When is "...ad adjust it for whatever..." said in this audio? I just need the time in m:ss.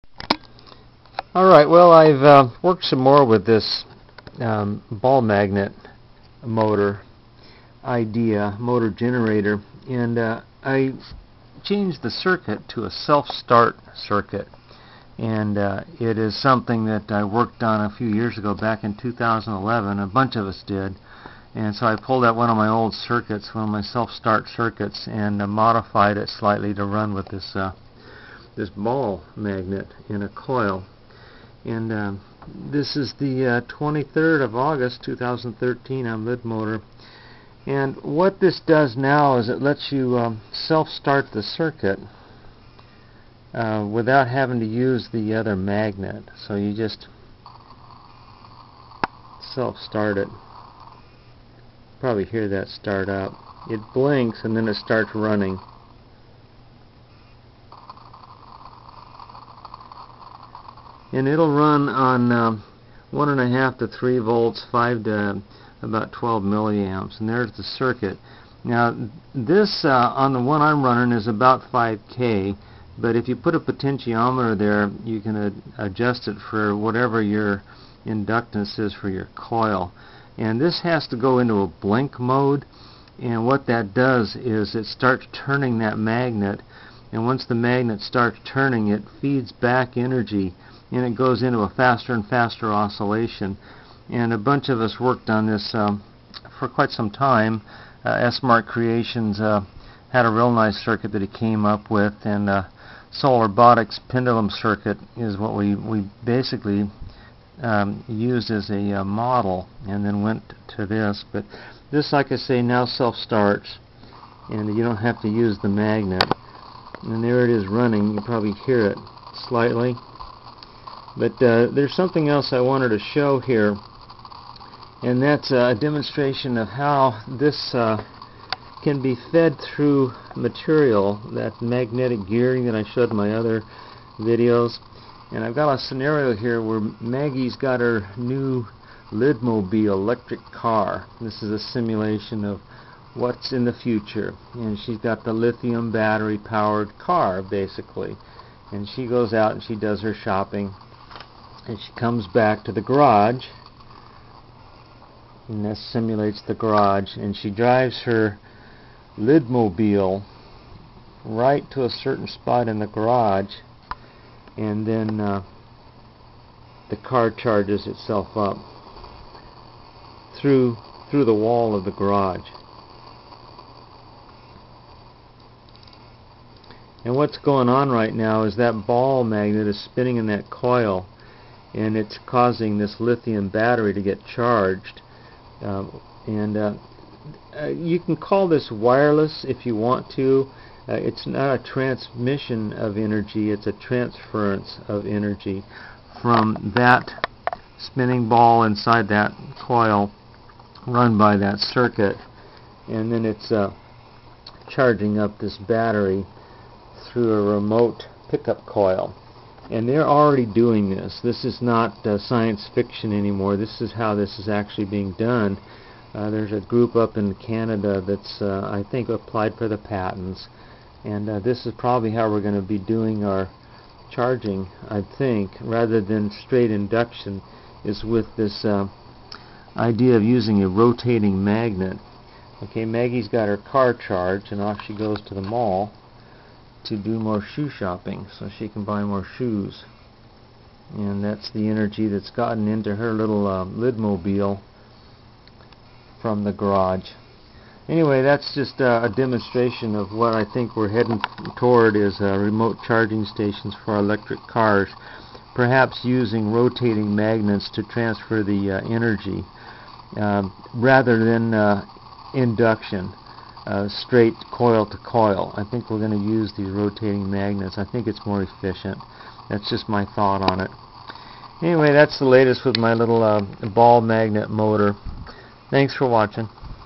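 1:15.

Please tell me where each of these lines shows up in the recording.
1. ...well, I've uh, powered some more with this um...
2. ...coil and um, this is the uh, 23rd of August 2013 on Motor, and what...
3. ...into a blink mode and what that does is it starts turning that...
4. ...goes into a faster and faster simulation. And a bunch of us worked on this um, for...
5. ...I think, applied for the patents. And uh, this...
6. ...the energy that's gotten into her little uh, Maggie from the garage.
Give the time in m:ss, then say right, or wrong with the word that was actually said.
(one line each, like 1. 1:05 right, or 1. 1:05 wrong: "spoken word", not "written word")
1. 0:01 wrong: "worked", not "powered"
2. 0:30 right
3. 1:21 right
4. 1:31 wrong: "oscillation", not "simulation"
5. 3:38 right
6. 4:01 wrong: "Lidmobile", not "Maggie".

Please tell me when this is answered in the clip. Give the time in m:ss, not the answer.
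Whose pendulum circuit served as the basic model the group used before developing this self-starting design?
1:43.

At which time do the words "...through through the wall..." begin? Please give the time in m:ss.
2:50.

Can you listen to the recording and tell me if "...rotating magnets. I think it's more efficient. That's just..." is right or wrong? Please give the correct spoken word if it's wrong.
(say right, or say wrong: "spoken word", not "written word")
right.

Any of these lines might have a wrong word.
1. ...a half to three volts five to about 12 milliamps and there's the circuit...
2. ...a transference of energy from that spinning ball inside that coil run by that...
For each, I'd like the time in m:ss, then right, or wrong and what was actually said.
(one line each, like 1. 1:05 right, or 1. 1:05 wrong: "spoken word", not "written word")
1. 1:03 right
2. 3:13 right.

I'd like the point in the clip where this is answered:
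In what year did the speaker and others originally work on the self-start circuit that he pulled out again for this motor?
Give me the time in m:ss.
0:18.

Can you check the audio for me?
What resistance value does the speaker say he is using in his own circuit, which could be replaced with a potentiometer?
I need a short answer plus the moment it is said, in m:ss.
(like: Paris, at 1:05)
5k, at 1:11.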